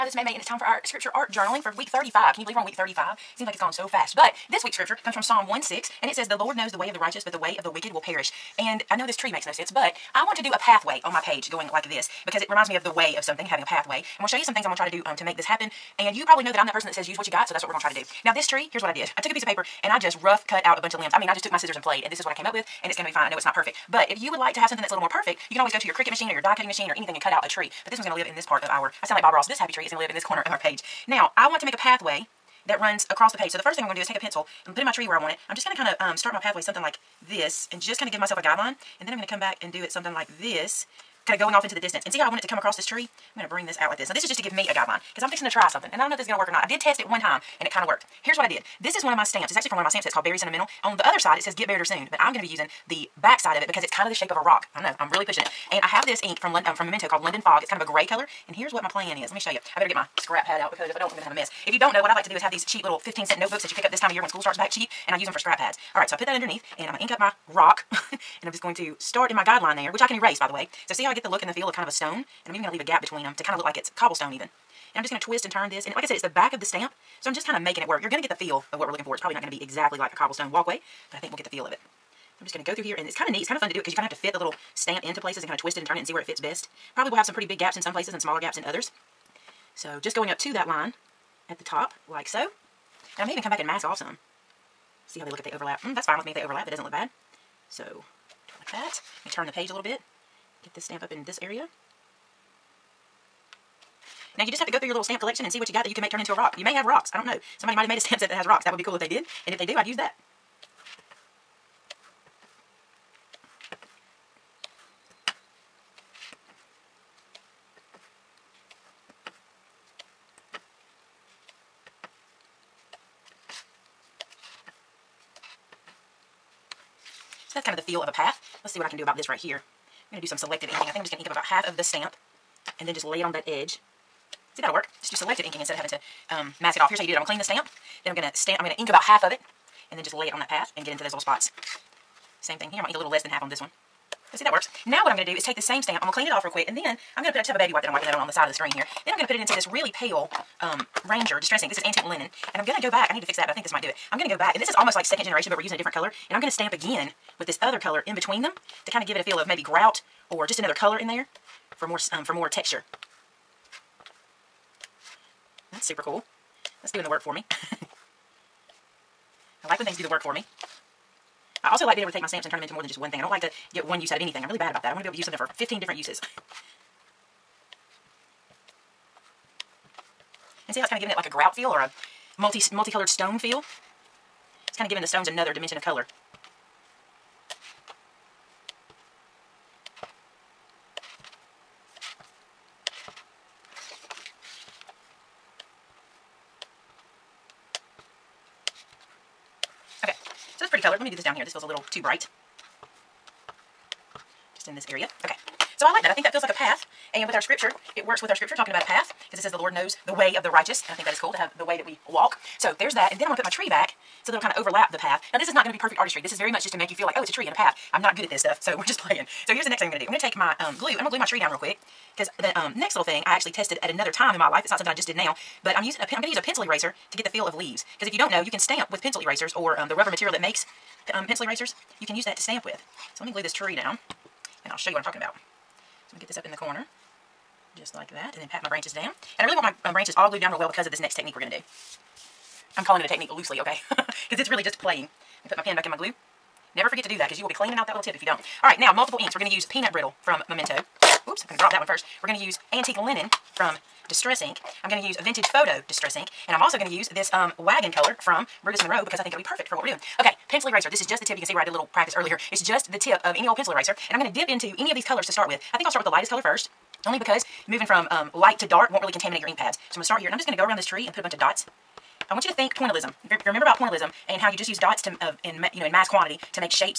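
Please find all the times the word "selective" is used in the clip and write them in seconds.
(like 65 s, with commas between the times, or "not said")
130 s, 135 s.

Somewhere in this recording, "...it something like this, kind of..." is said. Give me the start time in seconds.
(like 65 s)
39 s.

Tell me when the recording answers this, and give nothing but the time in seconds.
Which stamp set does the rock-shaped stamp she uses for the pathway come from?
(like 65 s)
50 s.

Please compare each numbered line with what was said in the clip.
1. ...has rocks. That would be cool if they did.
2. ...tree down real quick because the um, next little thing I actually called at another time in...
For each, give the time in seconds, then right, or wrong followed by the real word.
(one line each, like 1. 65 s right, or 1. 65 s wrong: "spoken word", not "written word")
1. 108 s right
2. 221 s wrong: "tested", not "called".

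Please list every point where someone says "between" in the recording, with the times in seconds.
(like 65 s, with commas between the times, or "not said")
73 s, 158 s.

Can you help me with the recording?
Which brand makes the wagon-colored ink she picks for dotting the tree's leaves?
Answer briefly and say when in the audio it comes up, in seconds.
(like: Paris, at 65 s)
Brutus Monroe, at 258 s.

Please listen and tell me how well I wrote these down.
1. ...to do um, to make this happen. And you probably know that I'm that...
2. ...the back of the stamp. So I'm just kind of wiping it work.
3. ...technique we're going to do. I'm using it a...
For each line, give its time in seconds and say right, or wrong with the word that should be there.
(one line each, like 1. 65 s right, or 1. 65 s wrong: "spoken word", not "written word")
1. 14 s right
2. 76 s wrong: "making", not "wiping"
3. 241 s wrong: "calling", not "using".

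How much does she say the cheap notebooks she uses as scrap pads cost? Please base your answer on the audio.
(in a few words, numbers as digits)
15 cents.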